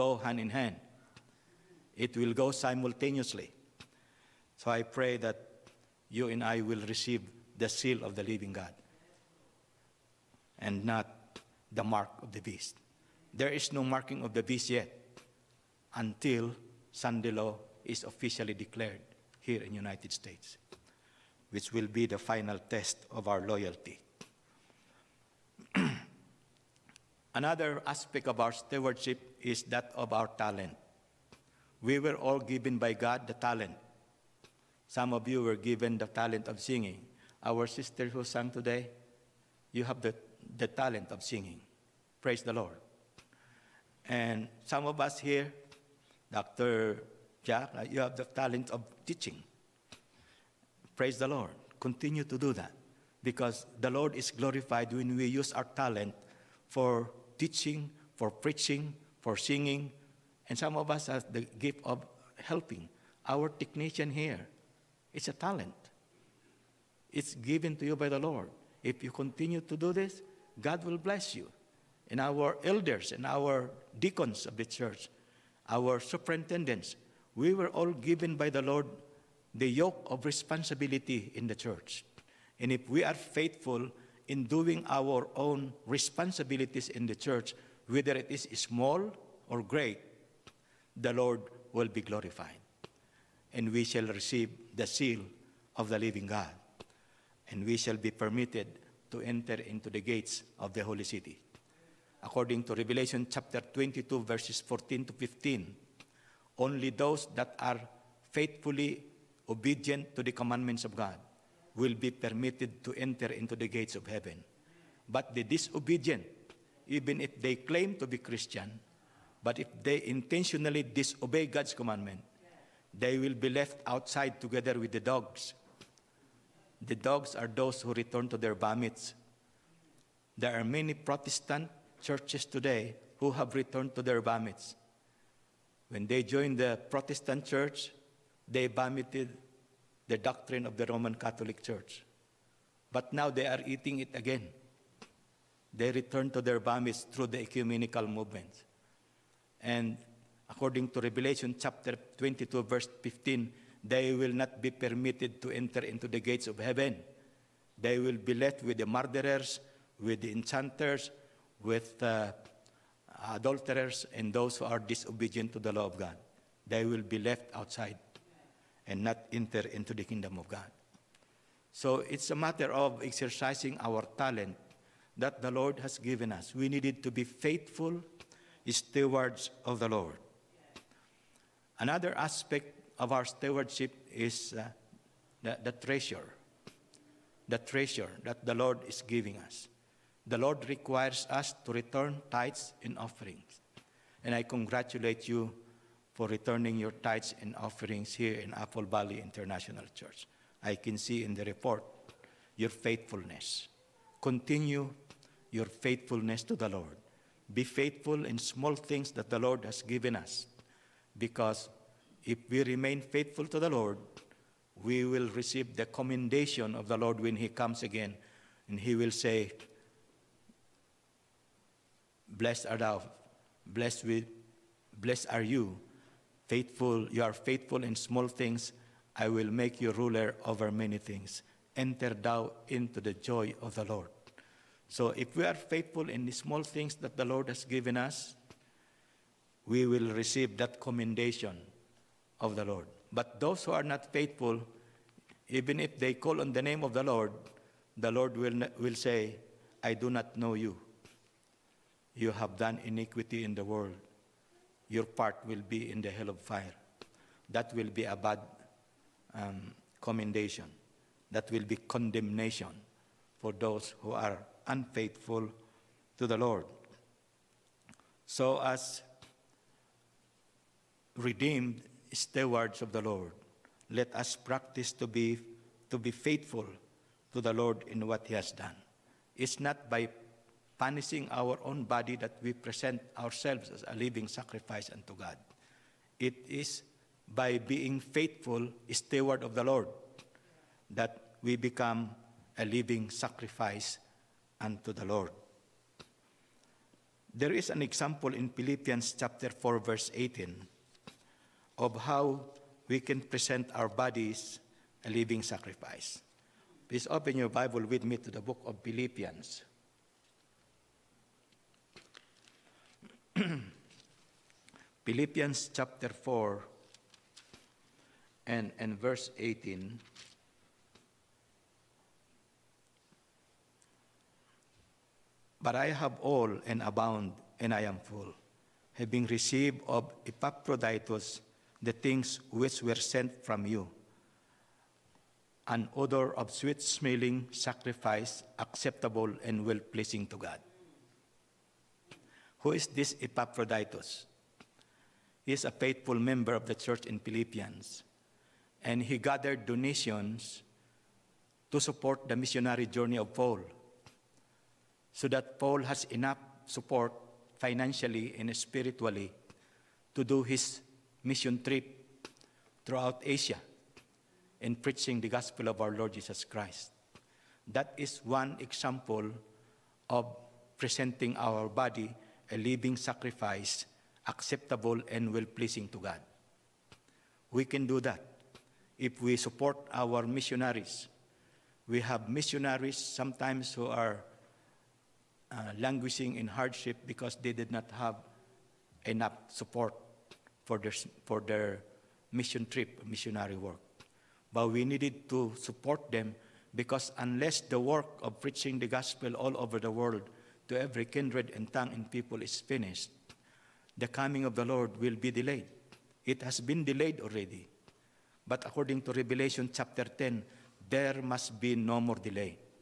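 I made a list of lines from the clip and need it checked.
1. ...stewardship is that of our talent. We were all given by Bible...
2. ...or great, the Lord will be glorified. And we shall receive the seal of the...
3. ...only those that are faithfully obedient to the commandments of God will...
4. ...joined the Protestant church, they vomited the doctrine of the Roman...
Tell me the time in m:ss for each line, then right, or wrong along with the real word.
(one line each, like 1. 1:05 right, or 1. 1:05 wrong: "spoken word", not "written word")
1. 0:28 wrong: "God", not "Bible"
2. 1:29 right
3. 1:46 right
4. 2:16 right.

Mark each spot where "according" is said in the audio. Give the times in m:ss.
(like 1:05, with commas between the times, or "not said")
1:42, 2:30, 6:48.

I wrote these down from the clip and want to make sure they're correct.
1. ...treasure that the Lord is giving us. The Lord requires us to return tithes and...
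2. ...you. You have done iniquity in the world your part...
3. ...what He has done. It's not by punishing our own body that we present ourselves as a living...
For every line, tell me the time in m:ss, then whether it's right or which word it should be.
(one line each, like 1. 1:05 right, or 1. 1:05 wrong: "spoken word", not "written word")
1. 3:07 right
2. 4:10 right
3. 4:38 right.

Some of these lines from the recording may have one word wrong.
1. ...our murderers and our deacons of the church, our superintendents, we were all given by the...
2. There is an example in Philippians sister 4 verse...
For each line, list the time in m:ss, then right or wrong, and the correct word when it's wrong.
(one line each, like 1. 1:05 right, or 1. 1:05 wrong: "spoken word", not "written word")
1. 1:12 wrong: "elders", not "murderers"
2. 4:57 wrong: "chapter", not "sister".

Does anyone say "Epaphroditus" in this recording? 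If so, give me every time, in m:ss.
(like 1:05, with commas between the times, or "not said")
5:30, 5:43.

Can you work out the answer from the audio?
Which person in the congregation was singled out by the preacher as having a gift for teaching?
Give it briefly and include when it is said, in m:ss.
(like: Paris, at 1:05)
Dr. Jack, at 0:46.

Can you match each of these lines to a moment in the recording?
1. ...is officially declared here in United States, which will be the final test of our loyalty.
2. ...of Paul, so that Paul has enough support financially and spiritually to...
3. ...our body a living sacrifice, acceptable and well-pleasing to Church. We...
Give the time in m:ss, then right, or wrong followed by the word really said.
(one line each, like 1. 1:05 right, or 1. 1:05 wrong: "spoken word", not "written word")
1. 0:17 right
2. 5:53 right
3. 6:11 wrong: "God", not "Church".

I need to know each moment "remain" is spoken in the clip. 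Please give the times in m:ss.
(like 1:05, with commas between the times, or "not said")
3:32.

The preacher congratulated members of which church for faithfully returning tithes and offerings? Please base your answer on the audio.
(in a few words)
Apple Valley International Church.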